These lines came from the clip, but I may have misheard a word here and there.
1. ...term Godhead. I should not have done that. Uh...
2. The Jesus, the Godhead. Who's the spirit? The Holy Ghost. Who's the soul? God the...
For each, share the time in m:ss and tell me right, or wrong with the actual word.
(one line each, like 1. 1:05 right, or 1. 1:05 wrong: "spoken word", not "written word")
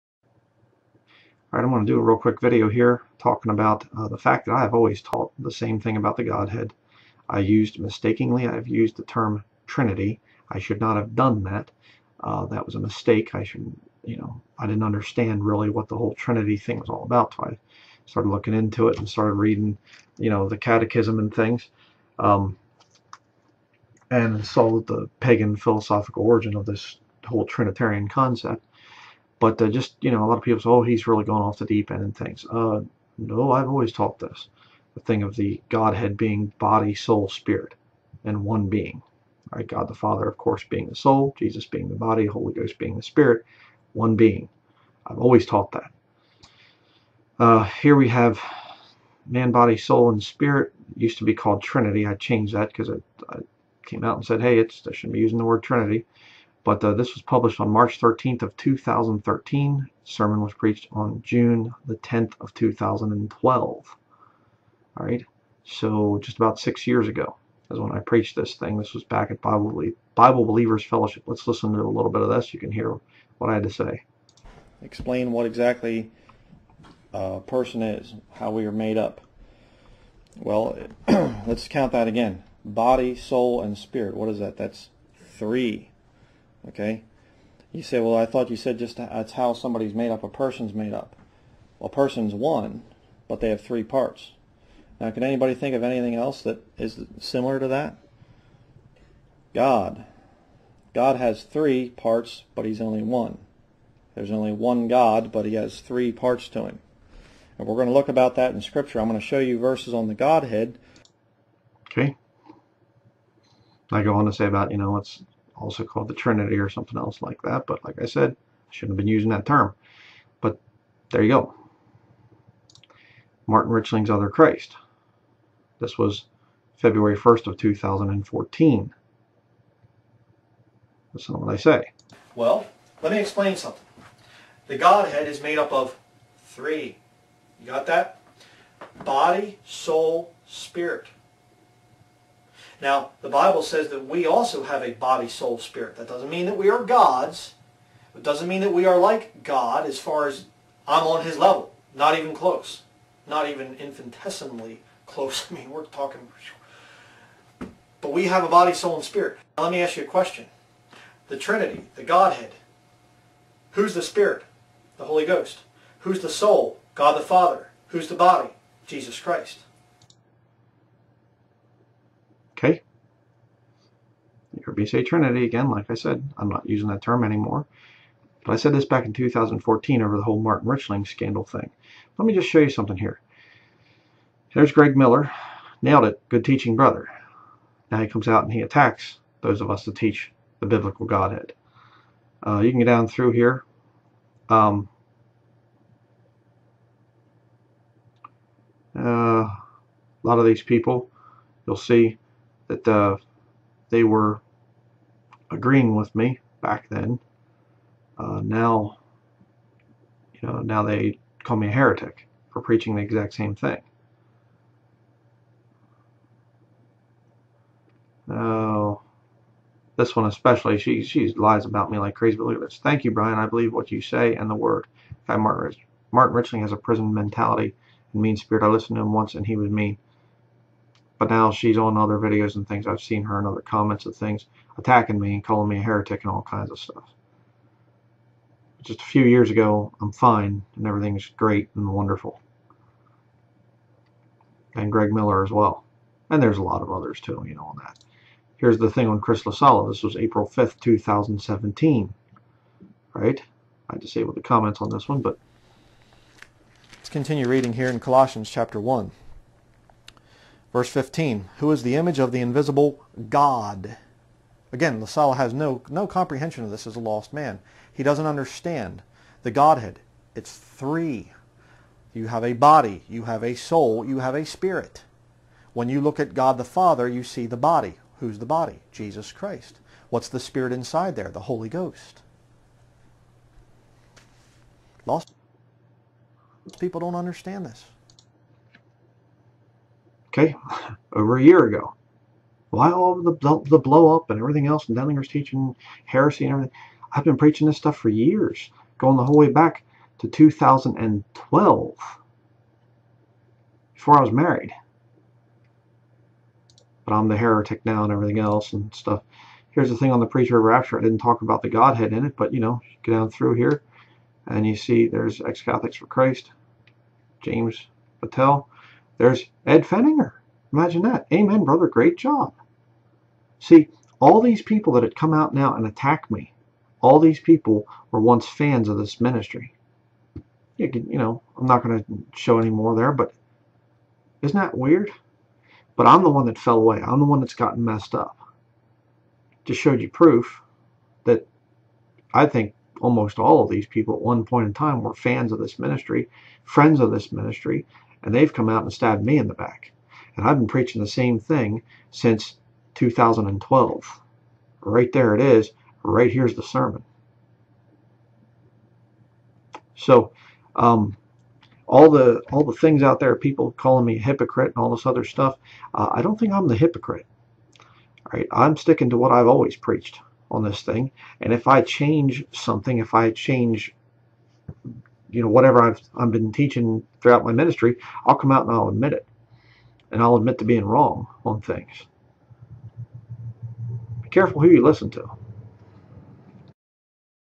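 1. 0:09 wrong: "Trinity", not "Godhead"
2. 2:41 wrong: "Trinity", not "Jesus".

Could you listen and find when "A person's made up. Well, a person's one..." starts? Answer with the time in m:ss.
1:30.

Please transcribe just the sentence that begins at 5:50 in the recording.
And I've been preaching the same thing since 2012.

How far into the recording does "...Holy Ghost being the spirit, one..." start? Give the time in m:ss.
0:42.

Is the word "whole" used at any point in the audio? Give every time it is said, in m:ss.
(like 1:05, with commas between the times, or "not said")
0:15, 0:27, 3:00, 4:59.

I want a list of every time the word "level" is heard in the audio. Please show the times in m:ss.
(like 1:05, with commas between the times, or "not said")
2:31.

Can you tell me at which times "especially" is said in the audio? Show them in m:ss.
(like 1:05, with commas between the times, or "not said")
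3:40.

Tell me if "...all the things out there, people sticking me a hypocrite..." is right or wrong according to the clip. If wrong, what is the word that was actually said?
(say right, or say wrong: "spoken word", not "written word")
wrong: "calling", not "sticking".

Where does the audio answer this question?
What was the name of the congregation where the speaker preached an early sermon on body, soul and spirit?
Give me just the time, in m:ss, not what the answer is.
1:10.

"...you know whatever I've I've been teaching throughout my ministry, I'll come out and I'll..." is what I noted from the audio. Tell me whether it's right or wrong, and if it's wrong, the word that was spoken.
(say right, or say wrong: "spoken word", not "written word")
right.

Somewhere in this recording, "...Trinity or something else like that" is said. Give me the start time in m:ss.
1:56.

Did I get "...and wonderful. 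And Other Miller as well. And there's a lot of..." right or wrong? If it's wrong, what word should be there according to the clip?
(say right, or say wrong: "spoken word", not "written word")
wrong: "Greg", not "Other".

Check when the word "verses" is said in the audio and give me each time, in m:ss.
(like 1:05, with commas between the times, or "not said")
1:49, 4:20.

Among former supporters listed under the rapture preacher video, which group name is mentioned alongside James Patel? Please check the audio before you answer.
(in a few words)
Ex-Catholics for Christ.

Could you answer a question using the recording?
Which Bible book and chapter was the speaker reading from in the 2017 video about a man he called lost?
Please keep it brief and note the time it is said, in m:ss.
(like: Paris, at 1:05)
Colossians 1, at 4:17.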